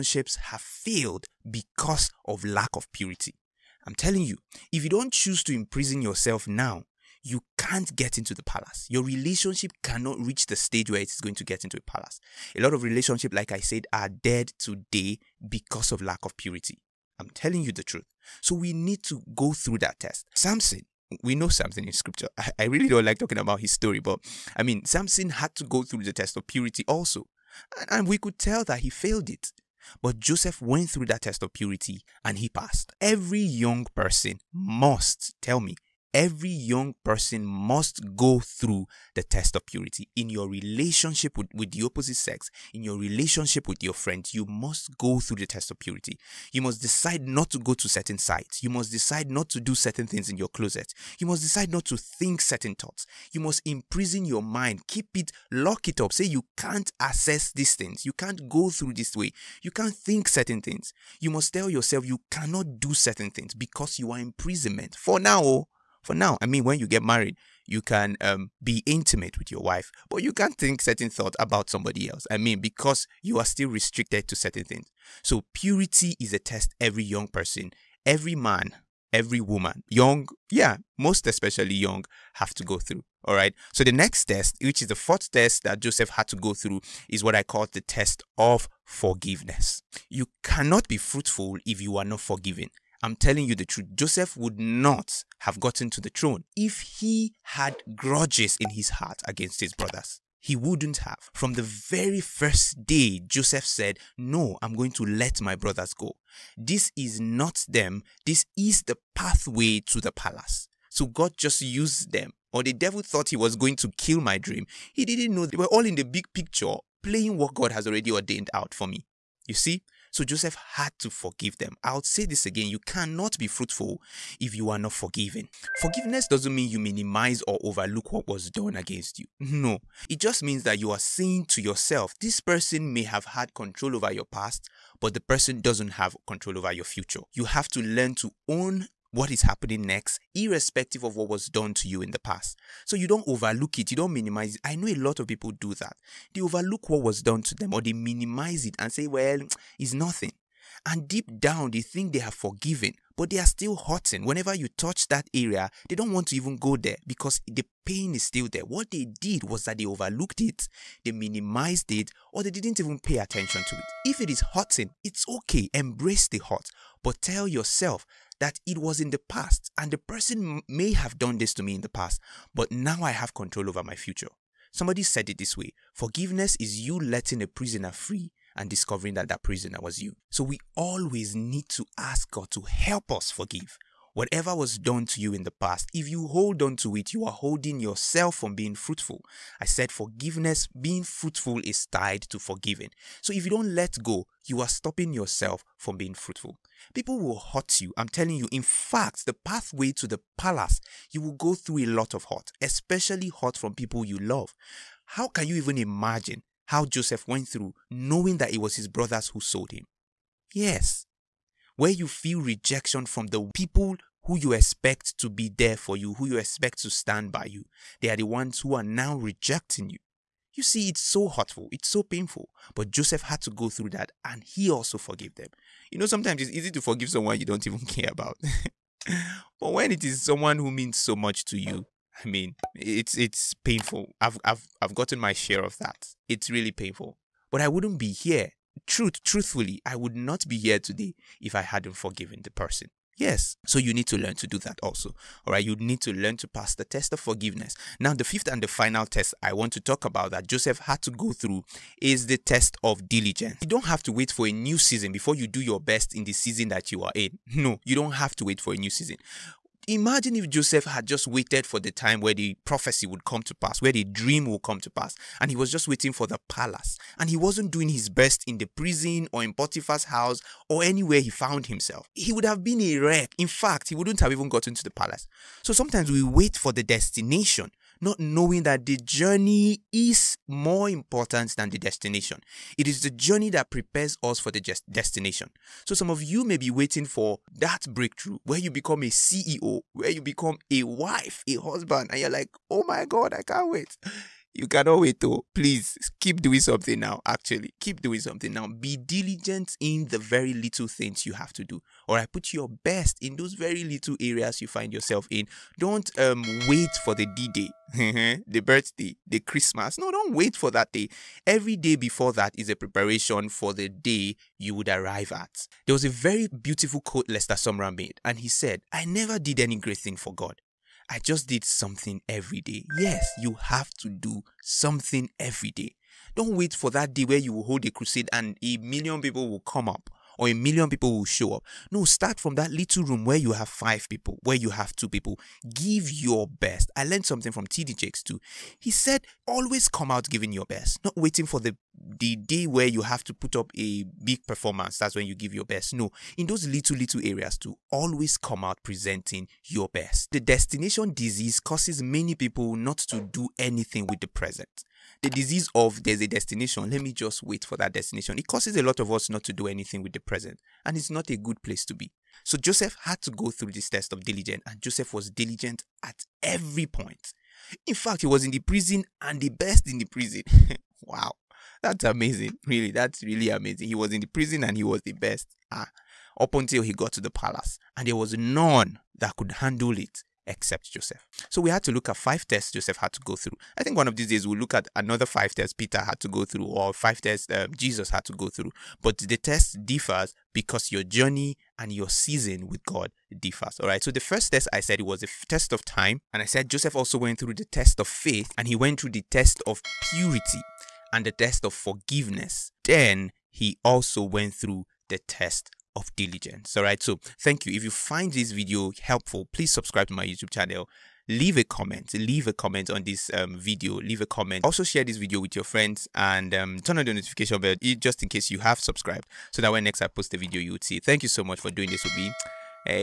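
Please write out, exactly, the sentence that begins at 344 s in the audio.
That's when you give your best.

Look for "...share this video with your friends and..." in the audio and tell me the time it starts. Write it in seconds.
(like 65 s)
414 s.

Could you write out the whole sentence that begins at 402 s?
Then he also went through the test of diligence.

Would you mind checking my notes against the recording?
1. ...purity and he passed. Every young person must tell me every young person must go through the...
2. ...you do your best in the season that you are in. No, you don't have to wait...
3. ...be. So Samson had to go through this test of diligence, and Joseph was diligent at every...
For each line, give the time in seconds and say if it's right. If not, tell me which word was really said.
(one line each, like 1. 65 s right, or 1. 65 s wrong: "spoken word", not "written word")
1. 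31 s right
2. 255 s right
3. 361 s wrong: "Joseph", not "Samson".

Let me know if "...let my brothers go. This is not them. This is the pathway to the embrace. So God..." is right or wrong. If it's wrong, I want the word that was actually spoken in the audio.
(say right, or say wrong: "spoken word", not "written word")
wrong: "palace", not "embrace".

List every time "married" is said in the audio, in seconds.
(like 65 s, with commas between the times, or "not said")
67 s.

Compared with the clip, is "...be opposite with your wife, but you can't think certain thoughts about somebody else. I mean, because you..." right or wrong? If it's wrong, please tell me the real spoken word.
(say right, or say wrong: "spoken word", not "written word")
wrong: "intimate", not "opposite".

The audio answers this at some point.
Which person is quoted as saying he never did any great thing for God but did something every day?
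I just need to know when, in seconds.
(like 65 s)
317 s.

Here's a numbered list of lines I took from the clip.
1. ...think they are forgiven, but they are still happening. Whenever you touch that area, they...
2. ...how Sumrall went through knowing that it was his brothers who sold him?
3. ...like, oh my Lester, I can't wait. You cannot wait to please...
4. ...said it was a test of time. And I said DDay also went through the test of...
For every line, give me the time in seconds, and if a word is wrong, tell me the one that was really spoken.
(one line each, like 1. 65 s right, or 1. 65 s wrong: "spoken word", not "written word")
1. 151 s wrong: "hurting", not "happening"
2. 206 s wrong: "Joseph", not "Sumrall"
3. 292 s wrong: "God", not "Lester"
4. 394 s wrong: "Joseph", not "DDay".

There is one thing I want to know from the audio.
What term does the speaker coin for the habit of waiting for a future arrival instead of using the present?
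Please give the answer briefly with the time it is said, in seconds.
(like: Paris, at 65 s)
Destination disease, at 350 s.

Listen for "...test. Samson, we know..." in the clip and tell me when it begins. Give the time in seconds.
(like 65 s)
19 s.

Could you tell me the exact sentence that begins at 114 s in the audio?
He didn't know they were all in the big picture, playing what God has already ordained out for me.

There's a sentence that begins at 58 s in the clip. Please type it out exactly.
You can't go through this way.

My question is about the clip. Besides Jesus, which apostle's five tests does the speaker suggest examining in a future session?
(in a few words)
Peter.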